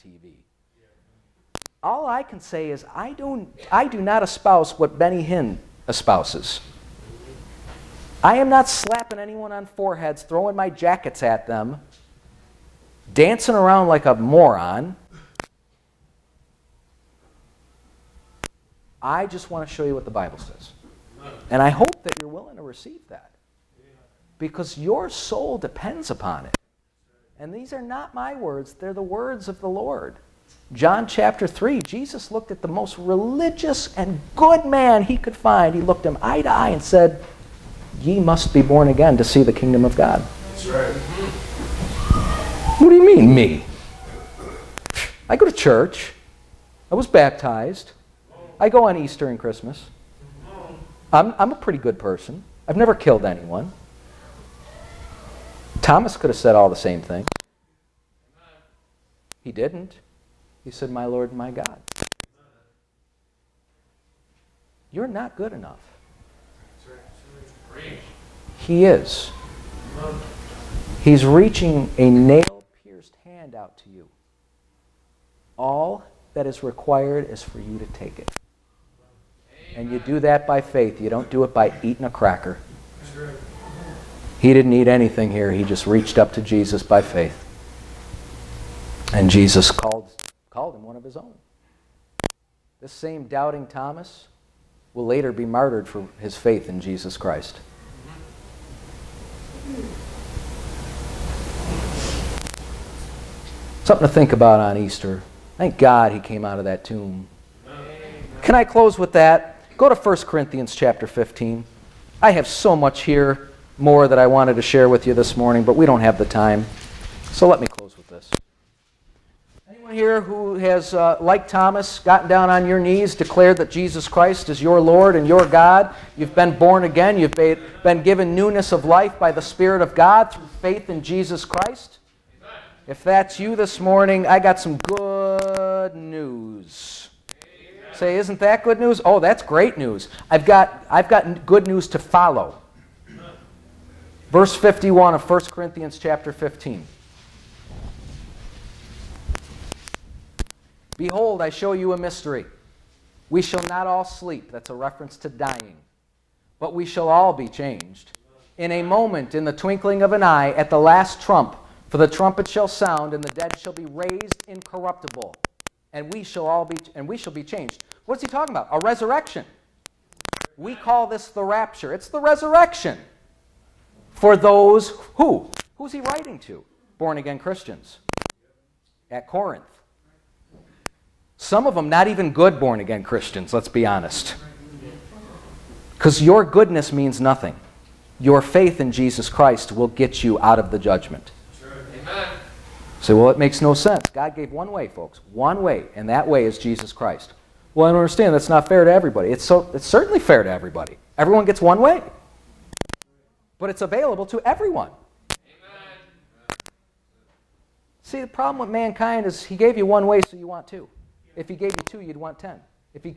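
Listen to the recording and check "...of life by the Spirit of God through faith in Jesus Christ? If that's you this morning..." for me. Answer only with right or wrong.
right.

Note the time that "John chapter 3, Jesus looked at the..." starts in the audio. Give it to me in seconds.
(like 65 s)
30 s.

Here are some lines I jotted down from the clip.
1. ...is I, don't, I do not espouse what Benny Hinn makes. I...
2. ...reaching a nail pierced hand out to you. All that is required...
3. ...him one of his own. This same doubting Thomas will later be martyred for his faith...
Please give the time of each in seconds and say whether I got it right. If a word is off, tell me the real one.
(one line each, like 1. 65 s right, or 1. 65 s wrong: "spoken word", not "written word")
1. 2 s wrong: "espouses", not "makes"
2. 71 s right
3. 90 s right.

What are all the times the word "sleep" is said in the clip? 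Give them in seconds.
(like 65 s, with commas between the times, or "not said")
154 s.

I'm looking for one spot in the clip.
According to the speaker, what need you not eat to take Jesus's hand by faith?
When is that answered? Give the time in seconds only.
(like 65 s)
82 s.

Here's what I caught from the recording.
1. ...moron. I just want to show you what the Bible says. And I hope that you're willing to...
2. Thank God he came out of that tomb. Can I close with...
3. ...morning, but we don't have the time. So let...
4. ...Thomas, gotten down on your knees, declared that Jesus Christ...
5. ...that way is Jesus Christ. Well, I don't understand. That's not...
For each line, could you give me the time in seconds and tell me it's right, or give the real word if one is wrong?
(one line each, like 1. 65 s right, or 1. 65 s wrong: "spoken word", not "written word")
1. 14 s right
2. 105 s right
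3. 115 s right
4. 121 s right
5. 196 s right.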